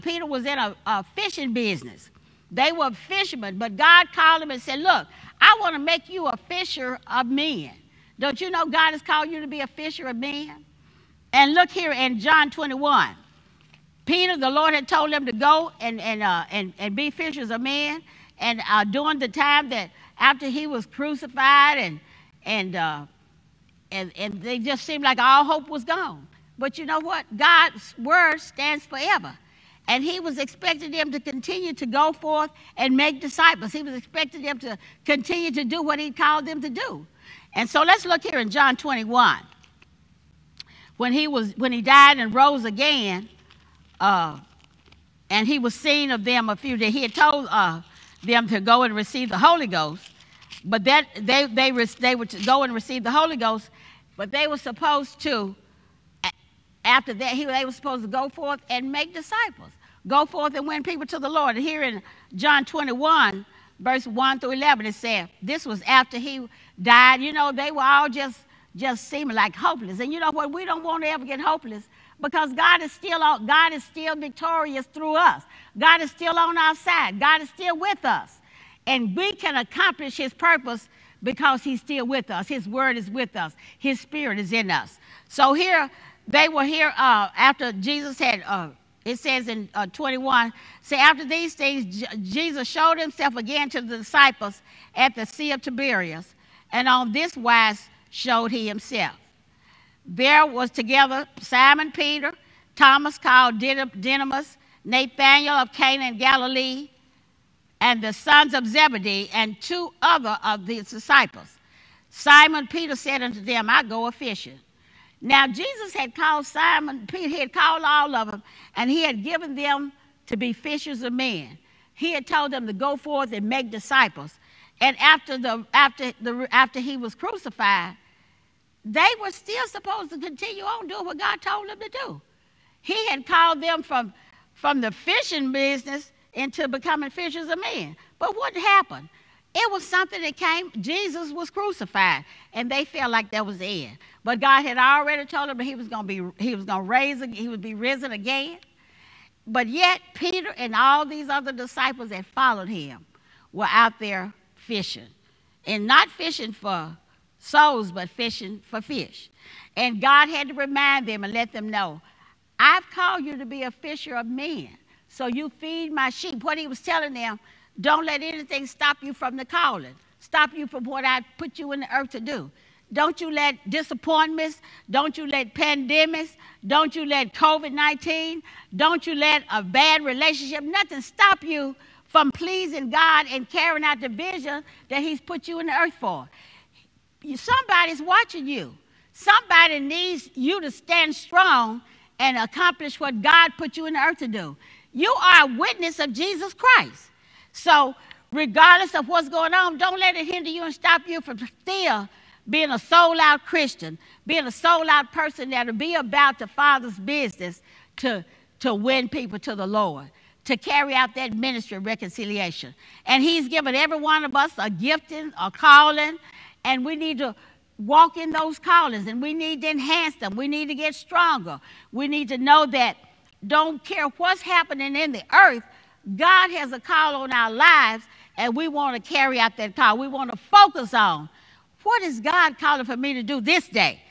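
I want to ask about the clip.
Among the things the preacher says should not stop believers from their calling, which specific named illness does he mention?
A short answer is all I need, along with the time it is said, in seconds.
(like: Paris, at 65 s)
COVID 19, at 177 s.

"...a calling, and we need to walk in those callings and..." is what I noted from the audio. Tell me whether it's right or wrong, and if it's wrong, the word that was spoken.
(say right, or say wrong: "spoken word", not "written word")
right.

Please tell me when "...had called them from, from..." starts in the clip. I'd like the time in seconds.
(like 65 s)
133 s.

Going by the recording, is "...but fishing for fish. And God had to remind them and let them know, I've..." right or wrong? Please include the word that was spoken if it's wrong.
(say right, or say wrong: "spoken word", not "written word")
right.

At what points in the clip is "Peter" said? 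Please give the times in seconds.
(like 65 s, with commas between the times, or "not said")
14 s, 101 s, 112 s, 117 s, 150 s.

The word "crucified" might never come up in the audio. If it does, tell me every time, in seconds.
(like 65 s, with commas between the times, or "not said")
20 s, 127 s, 141 s.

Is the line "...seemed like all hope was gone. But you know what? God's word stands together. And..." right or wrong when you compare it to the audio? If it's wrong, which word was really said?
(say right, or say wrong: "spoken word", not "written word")
wrong: "forever", not "together".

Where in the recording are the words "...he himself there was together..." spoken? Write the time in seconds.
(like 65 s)
98 s.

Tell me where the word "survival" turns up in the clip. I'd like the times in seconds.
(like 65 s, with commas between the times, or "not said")
not said.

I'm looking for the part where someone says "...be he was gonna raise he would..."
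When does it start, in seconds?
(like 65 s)
146 s.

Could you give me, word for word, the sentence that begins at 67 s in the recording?
You know, they were all just, just seeming like hopeless.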